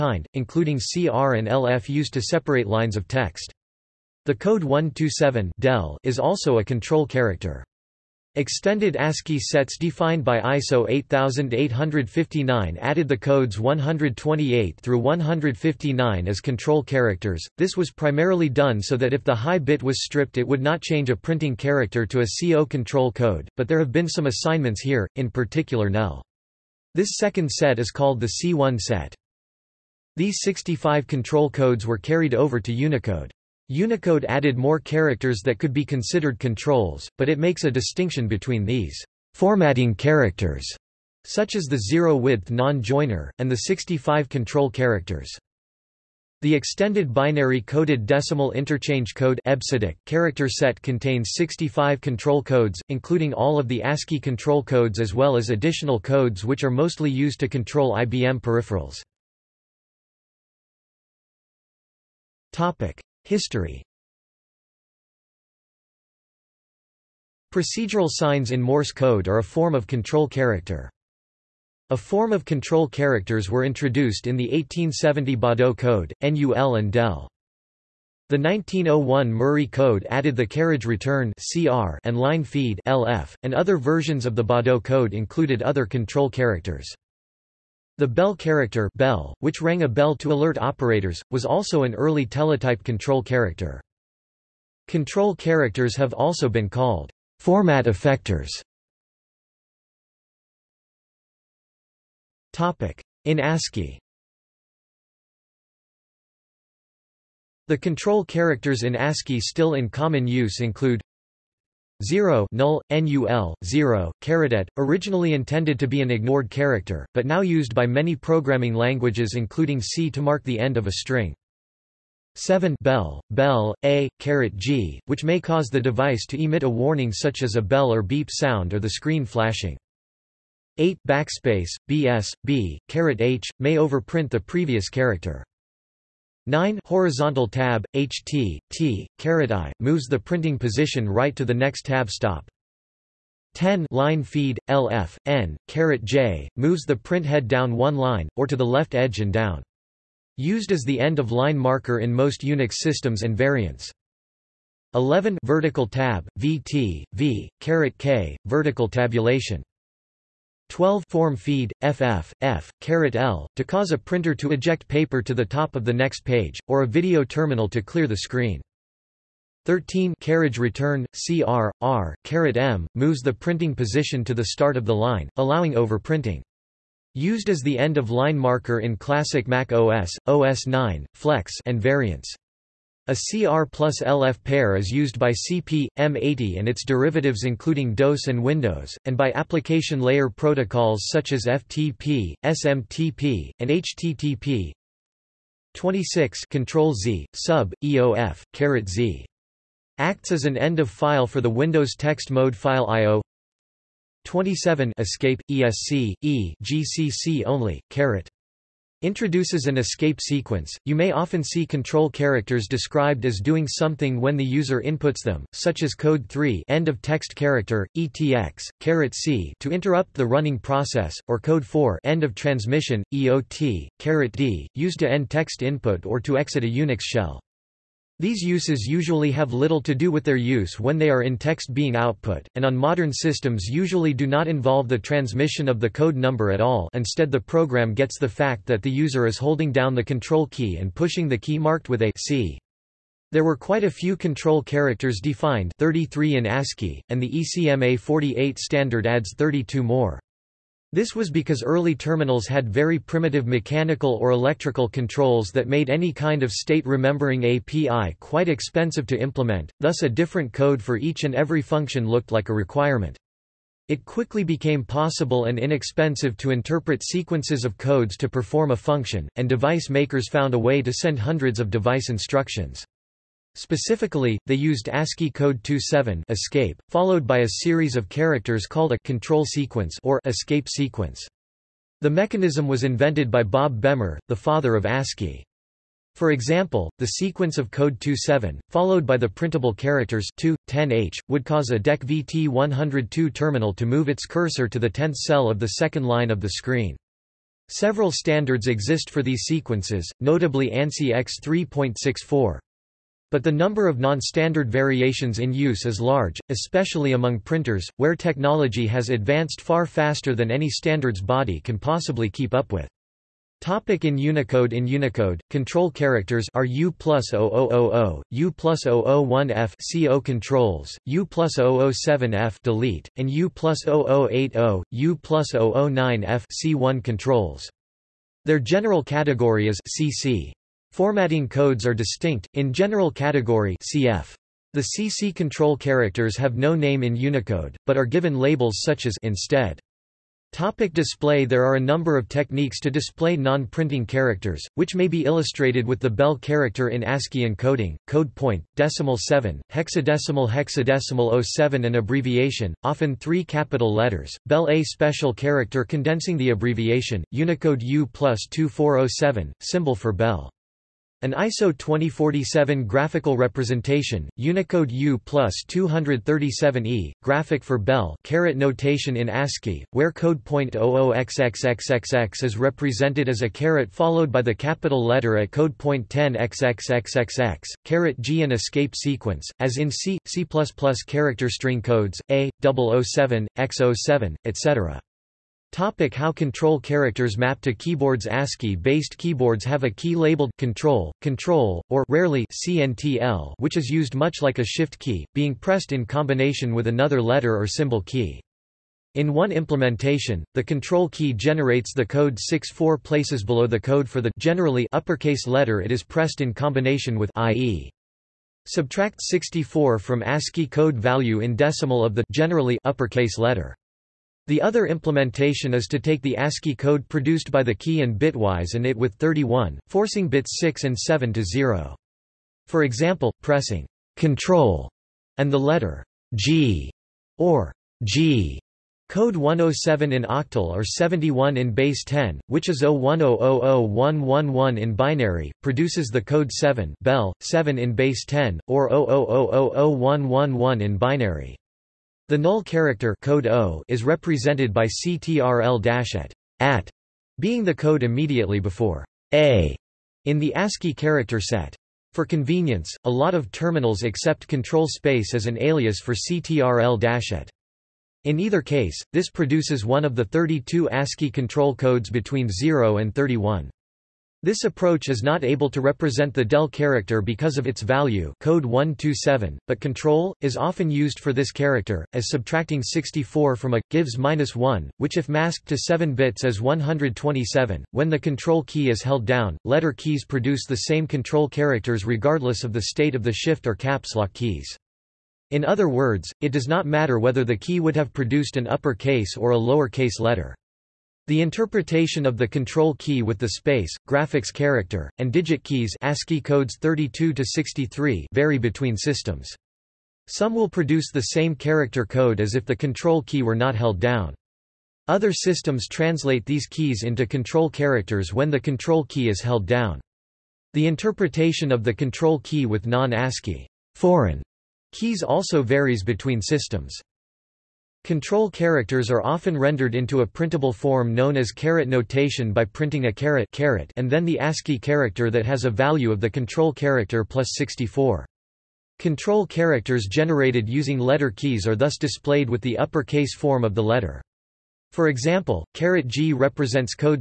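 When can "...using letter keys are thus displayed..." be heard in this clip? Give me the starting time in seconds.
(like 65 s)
530 s.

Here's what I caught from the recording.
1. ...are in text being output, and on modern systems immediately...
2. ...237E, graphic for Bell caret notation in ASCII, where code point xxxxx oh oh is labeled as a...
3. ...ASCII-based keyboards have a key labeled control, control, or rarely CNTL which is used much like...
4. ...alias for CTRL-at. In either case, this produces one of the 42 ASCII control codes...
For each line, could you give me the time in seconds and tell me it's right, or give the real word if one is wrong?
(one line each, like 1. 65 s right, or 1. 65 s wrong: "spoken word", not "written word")
1. 231 s wrong: "usually", not "immediately"
2. 365 s wrong: "represented", not "labeled"
3. 388 s right
4. 455 s wrong: "32", not "42".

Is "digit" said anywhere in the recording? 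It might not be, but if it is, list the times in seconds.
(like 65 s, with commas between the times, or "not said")
495 s.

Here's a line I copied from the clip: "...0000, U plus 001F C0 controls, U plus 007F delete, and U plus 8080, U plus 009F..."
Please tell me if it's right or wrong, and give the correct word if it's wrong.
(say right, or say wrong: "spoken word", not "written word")
wrong: "0080", not "8080".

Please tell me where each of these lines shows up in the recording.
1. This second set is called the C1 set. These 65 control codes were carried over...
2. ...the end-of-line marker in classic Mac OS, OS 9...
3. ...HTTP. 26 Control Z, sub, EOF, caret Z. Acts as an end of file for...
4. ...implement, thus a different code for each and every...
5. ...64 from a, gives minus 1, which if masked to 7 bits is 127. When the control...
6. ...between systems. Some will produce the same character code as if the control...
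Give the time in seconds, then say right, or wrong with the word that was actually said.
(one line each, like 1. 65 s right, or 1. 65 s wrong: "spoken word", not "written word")
1. 26 s right
2. 177 s right
3. 193 s right
4. 259 s right
5. 472 s right
6. 498 s right.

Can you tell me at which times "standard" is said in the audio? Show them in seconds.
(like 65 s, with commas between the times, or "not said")
248 s, 298 s, 303 s, 310 s.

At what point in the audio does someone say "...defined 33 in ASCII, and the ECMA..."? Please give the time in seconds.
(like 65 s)
245 s.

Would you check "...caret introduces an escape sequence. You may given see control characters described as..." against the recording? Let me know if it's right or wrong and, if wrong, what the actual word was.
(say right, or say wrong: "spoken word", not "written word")
wrong: "often", not "given".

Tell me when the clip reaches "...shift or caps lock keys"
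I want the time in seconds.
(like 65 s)
483 s.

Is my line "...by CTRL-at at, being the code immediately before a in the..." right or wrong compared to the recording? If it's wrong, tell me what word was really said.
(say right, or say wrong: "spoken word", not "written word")
right.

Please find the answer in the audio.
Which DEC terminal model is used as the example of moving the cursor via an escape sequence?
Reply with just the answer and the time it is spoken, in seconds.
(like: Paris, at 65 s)
VT102, at 292 s.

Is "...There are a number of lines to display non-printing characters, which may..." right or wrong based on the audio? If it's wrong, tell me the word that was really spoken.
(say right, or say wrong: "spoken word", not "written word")
wrong: "techniques", not "lines".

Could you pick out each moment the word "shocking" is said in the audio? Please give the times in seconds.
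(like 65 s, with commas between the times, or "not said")
not said.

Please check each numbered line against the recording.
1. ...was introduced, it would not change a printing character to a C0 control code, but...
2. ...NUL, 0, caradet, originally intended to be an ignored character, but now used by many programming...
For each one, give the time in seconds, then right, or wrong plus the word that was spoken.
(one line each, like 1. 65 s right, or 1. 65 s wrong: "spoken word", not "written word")
1. 19 s wrong: "stripped", not "introduced"
2. 112 s right.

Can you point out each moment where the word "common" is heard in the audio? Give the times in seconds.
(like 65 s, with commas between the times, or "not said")
109 s.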